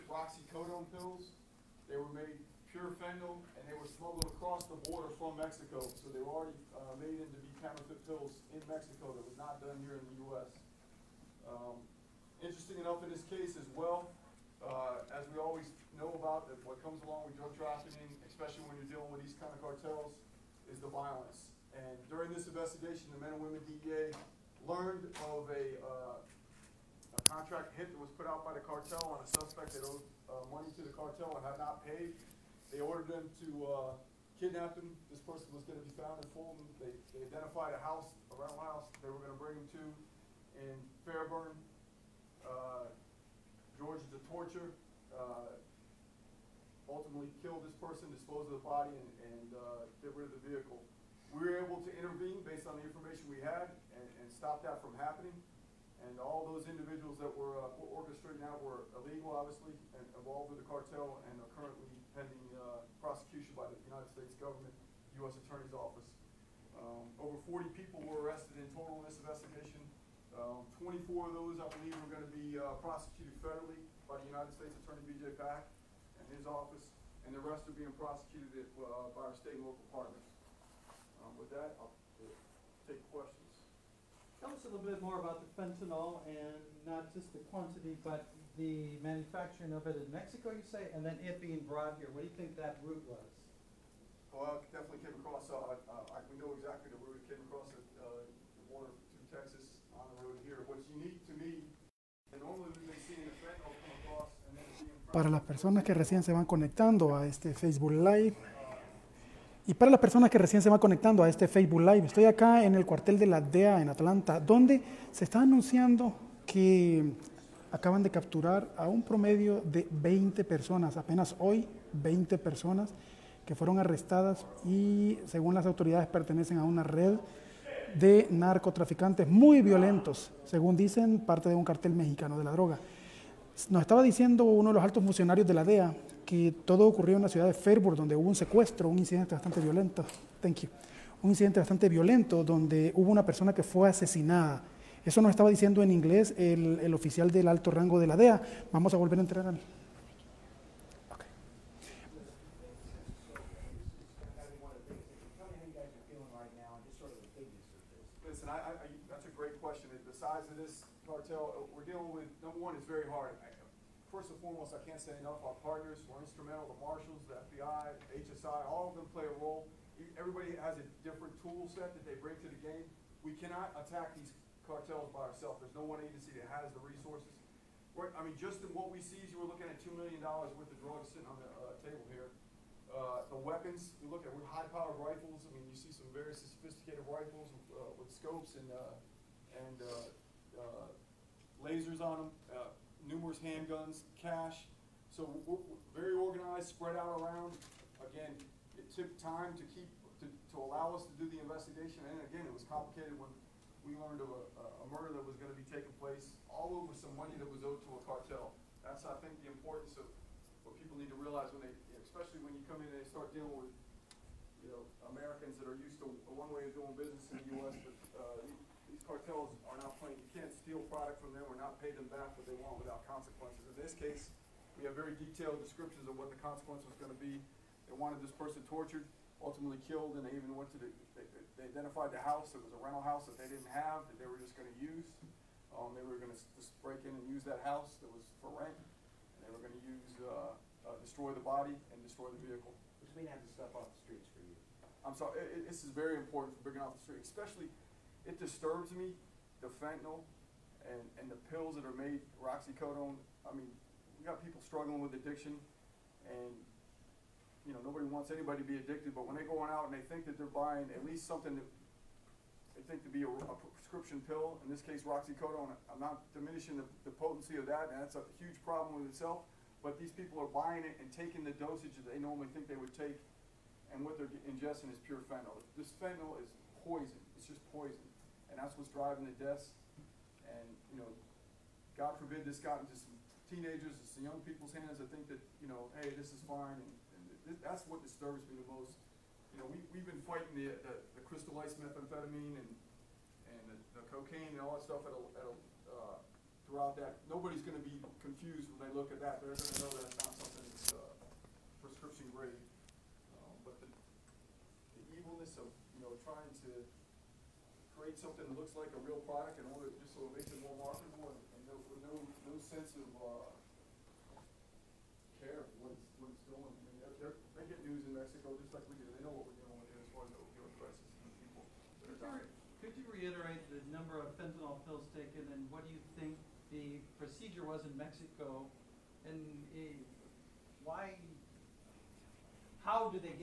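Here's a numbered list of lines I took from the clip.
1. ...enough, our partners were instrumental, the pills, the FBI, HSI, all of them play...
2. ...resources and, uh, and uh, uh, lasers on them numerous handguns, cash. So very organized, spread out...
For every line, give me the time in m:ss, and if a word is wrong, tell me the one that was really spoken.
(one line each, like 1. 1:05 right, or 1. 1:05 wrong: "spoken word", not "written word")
1. 2:45 wrong: "marshals", not "pills"
2. 3:08 wrong: "scopes", not "resources".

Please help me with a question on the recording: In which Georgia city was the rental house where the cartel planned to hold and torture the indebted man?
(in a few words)
Fairburn.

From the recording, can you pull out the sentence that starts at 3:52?
It was a rental house that they didn't have, that they were just going to use.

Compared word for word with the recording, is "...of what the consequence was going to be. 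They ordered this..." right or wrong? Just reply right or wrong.
wrong.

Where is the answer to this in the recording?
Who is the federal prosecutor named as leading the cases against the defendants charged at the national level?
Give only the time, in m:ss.
1:15.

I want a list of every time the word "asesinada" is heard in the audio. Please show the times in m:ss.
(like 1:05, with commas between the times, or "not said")
2:23.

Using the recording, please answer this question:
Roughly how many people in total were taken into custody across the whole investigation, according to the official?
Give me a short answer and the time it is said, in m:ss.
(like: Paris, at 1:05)
over 40, at 1:07.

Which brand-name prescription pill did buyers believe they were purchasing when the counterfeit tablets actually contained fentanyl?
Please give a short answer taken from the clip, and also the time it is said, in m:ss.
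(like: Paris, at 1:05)
Roxicodone, at 4:25.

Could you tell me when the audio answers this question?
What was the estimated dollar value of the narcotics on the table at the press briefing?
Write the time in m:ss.
2:59.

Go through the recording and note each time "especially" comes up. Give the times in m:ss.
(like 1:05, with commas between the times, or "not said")
0:18, 3:32, 4:07.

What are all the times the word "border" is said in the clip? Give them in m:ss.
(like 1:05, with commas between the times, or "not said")
0:04, 1:38.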